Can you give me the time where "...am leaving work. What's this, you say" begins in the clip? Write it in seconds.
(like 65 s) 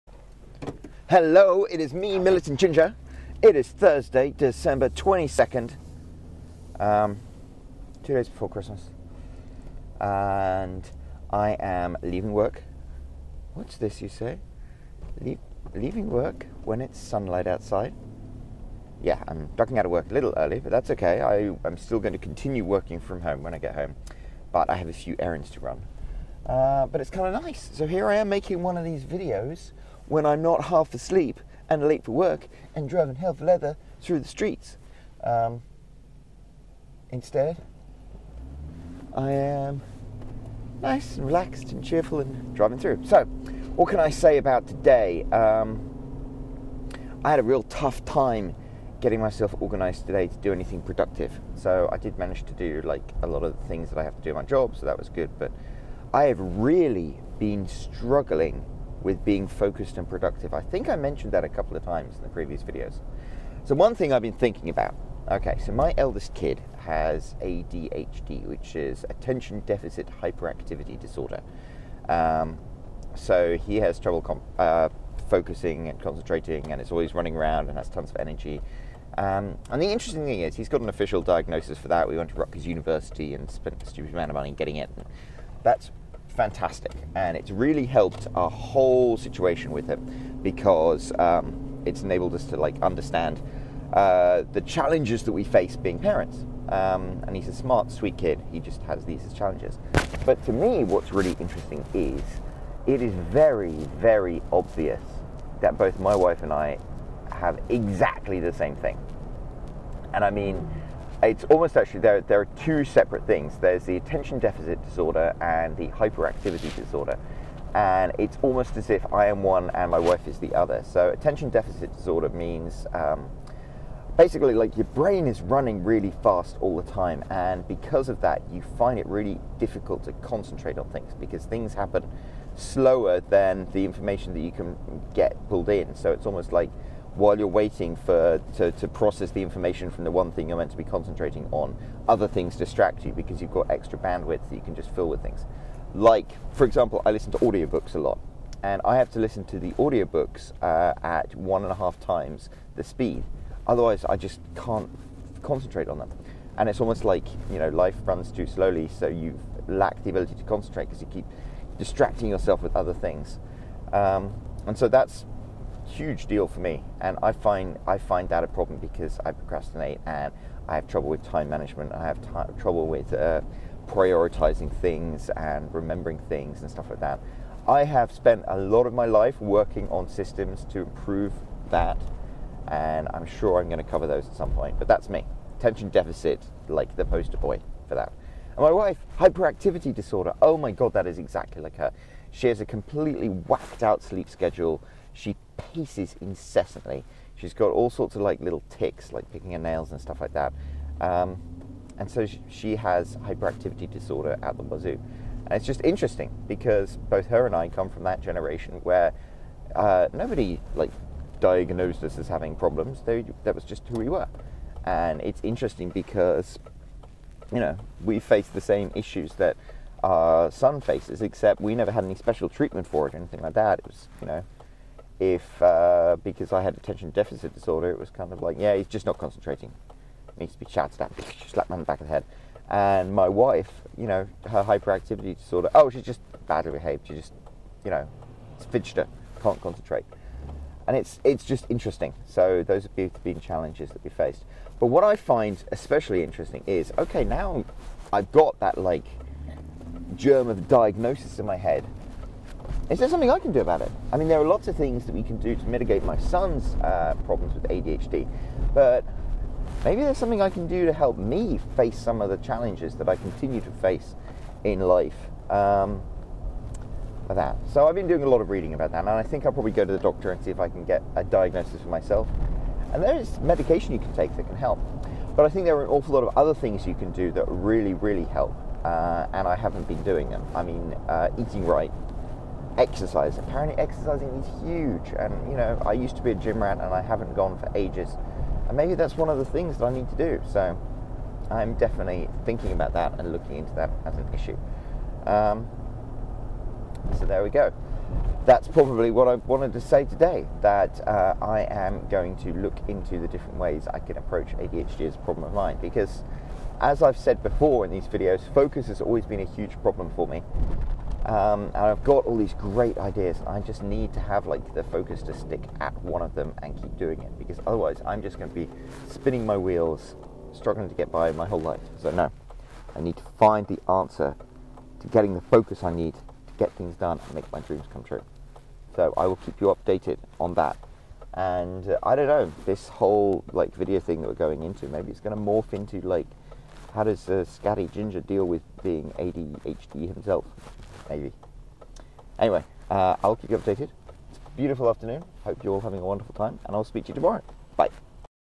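11 s.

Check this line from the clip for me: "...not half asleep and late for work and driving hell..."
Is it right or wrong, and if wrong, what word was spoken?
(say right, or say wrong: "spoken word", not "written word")
right.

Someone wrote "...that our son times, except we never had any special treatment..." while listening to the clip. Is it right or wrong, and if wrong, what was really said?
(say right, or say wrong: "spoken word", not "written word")
wrong: "faces", not "times".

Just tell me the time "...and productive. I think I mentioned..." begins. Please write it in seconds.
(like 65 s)
59 s.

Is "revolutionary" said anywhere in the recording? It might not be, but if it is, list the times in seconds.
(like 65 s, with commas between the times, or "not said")
not said.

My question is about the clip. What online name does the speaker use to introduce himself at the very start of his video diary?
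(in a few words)
Militant Ginger.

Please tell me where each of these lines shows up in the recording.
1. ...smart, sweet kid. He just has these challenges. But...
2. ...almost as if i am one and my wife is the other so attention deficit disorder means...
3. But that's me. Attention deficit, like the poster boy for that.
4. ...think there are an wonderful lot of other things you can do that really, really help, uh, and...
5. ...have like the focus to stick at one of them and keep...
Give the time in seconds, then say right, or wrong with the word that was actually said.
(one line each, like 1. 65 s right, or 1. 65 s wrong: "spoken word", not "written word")
1. 97 s right
2. 118 s right
3. 184 s right
4. 275 s wrong: "awful", not "wonderful"
5. 314 s right.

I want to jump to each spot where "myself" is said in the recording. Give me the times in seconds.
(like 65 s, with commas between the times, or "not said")
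49 s, 271 s.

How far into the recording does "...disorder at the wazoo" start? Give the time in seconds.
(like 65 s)
203 s.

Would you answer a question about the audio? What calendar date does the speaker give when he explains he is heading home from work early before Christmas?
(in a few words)
December 22nd.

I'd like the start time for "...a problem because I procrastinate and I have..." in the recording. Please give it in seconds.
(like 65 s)
168 s.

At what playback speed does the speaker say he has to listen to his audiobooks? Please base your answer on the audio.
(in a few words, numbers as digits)
1.5 times.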